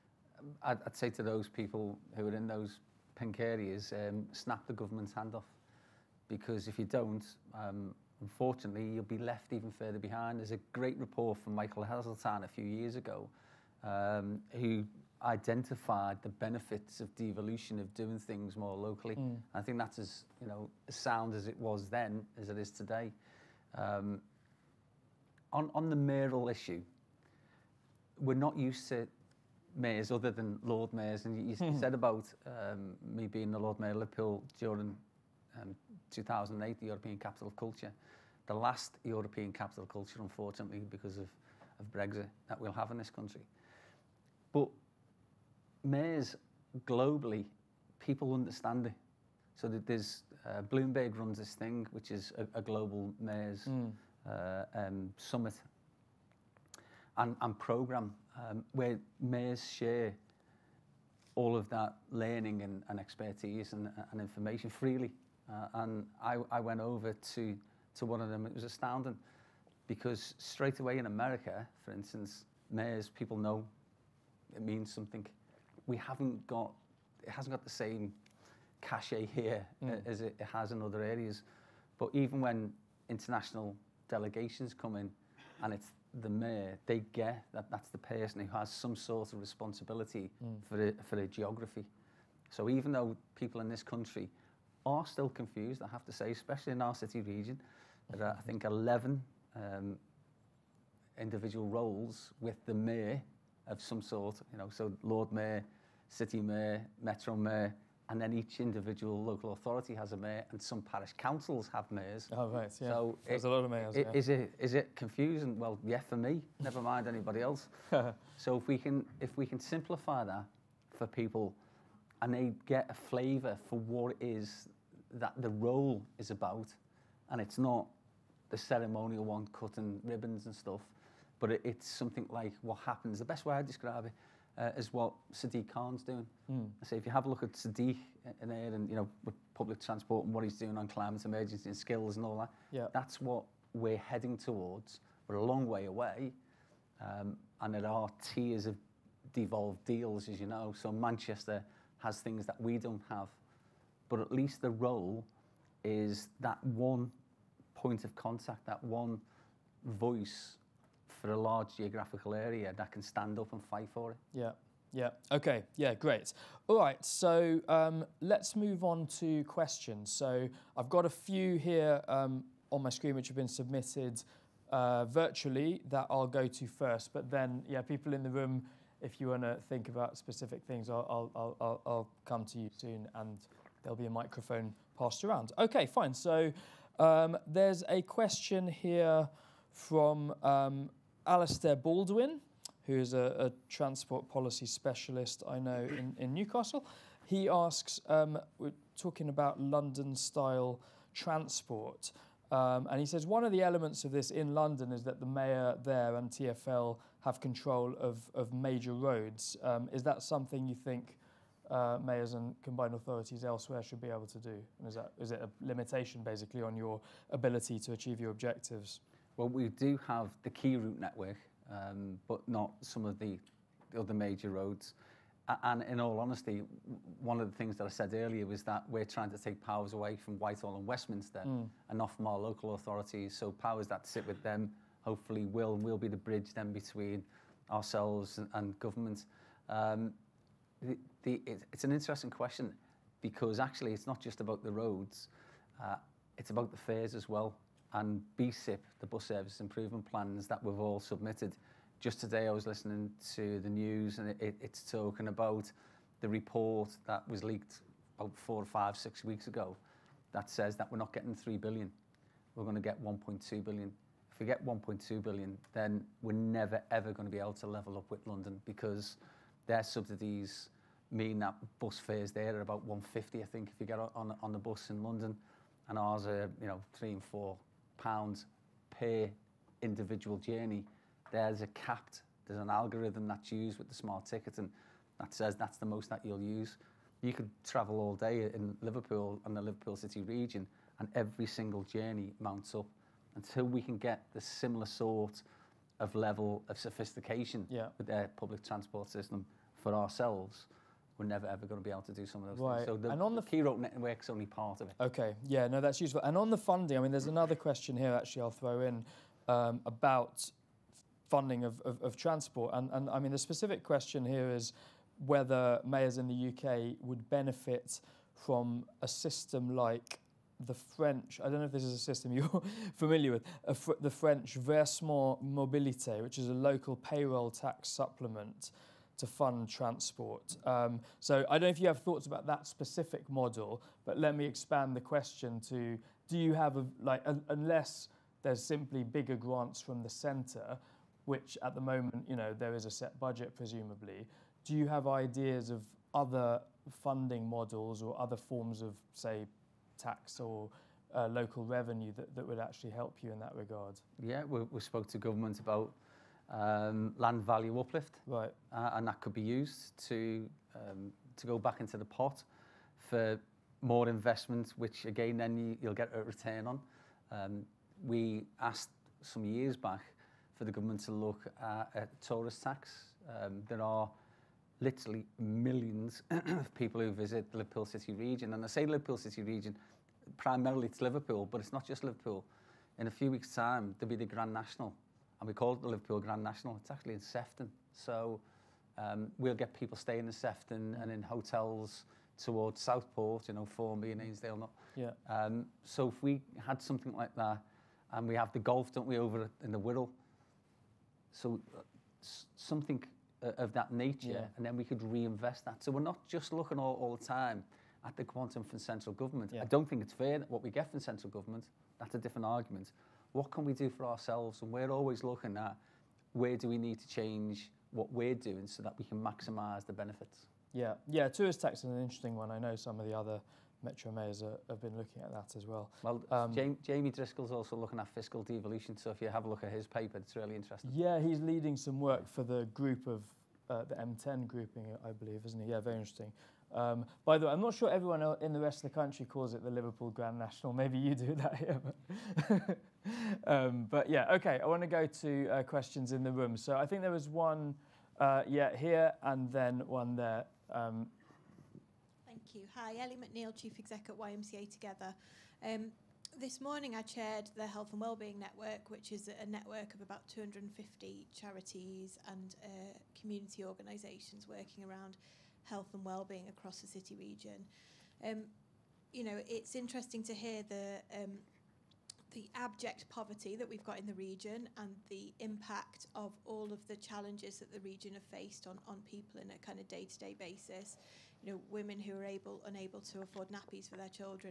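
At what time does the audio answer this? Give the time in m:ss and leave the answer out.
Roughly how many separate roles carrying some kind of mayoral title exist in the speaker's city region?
1:38.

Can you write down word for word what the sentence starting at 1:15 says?
we haven't got, it hasn't got the same cachet here mm.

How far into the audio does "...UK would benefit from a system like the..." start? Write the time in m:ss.
5:16.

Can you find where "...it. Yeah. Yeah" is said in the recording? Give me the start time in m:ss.
2:44.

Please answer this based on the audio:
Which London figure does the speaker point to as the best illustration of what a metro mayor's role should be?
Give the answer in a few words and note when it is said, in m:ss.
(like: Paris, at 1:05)
Sadiq Khan, at 2:15.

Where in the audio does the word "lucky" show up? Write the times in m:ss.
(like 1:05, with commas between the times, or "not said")
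not said.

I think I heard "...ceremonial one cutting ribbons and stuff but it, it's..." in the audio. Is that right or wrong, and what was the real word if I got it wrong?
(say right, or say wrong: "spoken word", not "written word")
right.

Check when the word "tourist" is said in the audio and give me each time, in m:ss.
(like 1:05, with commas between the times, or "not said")
6:12, 7:01.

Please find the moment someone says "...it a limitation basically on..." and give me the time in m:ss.
3:35.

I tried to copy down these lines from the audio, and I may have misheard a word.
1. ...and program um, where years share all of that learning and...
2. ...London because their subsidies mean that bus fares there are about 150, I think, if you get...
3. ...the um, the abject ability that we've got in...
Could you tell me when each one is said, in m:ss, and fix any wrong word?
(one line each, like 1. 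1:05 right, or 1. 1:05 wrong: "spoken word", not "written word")
1. 0:57 wrong: "mayors", not "years"
2. 4:28 right
3. 7:50 wrong: "poverty", not "ability".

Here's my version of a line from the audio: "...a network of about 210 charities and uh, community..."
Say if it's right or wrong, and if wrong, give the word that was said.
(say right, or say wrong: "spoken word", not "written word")
wrong: "250", not "210".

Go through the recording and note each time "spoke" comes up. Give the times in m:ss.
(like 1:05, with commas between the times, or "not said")
5:54.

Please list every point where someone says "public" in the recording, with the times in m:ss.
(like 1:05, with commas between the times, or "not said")
2:19, 4:58.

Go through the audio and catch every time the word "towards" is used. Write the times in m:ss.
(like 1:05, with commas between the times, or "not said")
2:24, 6:32.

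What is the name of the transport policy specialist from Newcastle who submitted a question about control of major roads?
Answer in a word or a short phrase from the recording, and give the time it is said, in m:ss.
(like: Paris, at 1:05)
Alastair Baldwin, at 3:11.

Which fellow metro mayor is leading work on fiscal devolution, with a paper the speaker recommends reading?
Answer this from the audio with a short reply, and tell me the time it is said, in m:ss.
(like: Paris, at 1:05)
Jamie Driscoll, at 7:06.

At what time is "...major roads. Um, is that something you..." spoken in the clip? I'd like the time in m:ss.
3:28.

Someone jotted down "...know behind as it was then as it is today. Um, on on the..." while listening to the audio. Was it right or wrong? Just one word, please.
wrong.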